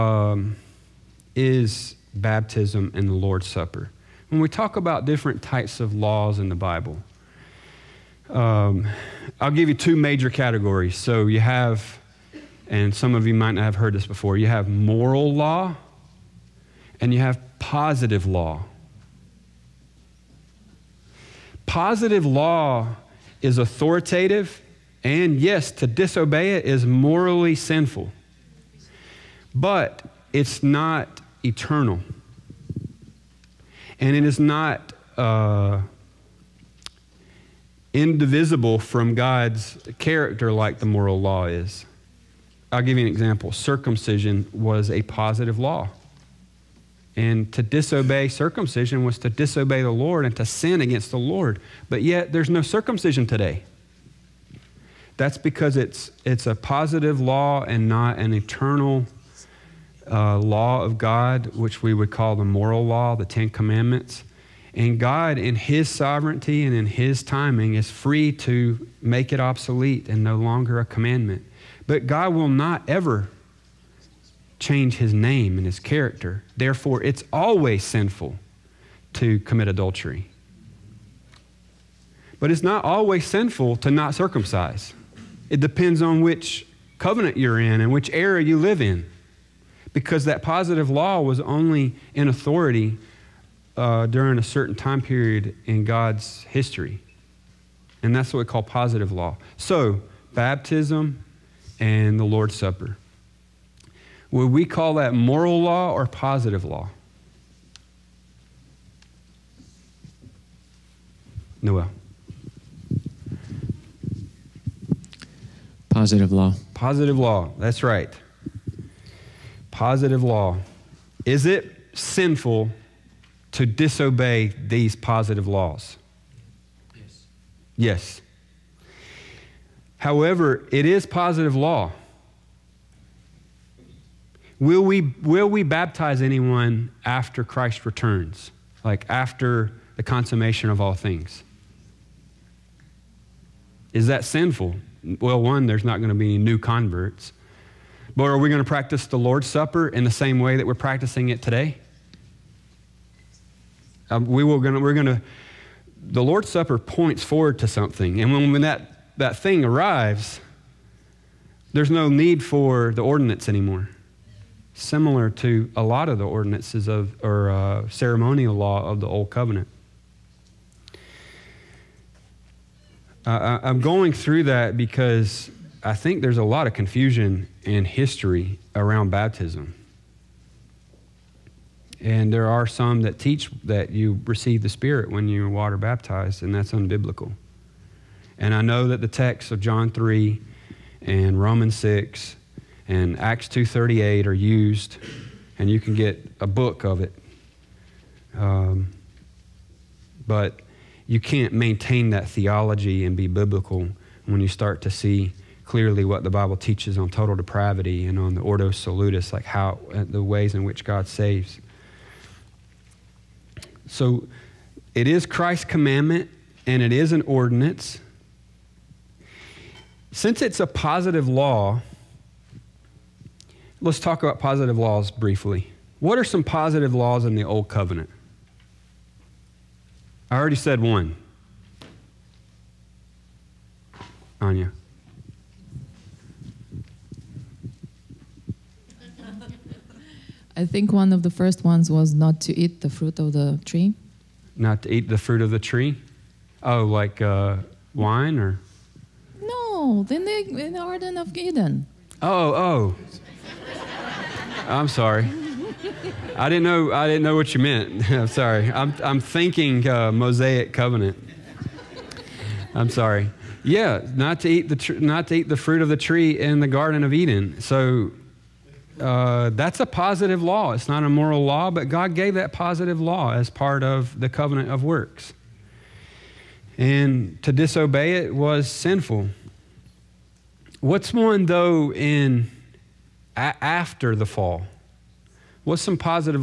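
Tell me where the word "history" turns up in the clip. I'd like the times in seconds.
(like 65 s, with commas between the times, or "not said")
96 s, 177 s.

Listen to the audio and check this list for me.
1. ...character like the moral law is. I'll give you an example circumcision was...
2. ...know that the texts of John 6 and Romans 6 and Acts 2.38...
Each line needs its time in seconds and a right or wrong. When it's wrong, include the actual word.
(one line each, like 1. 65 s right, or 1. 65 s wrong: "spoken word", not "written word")
1. 39 s right
2. 188 s wrong: "3", not "6".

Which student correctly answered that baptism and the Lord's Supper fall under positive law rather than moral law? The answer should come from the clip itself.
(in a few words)
Noel.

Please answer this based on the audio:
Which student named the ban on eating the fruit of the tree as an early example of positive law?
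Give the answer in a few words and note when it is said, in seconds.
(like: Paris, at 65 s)
Anya, at 234 s.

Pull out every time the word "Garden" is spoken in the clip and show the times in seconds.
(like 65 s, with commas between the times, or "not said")
250 s, 266 s.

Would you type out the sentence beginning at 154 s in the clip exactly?
Um, we will gonna, we're going to, the Lord's Supper points forward to something.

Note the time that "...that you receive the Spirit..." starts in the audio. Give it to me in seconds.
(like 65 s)
183 s.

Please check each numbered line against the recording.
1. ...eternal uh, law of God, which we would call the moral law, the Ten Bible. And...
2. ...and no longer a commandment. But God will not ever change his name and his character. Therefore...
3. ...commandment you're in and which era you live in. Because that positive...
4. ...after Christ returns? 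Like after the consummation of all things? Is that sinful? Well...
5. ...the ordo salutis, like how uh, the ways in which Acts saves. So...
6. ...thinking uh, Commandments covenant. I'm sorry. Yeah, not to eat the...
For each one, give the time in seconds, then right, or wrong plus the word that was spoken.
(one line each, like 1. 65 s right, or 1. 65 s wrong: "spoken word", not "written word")
1. 58 s wrong: "Commandments", not "Bible"
2. 70 s right
3. 86 s wrong: "covenant", not "commandment"
4. 137 s right
5. 208 s wrong: "God", not "Acts"
6. 259 s wrong: "Mosaic", not "Commandments".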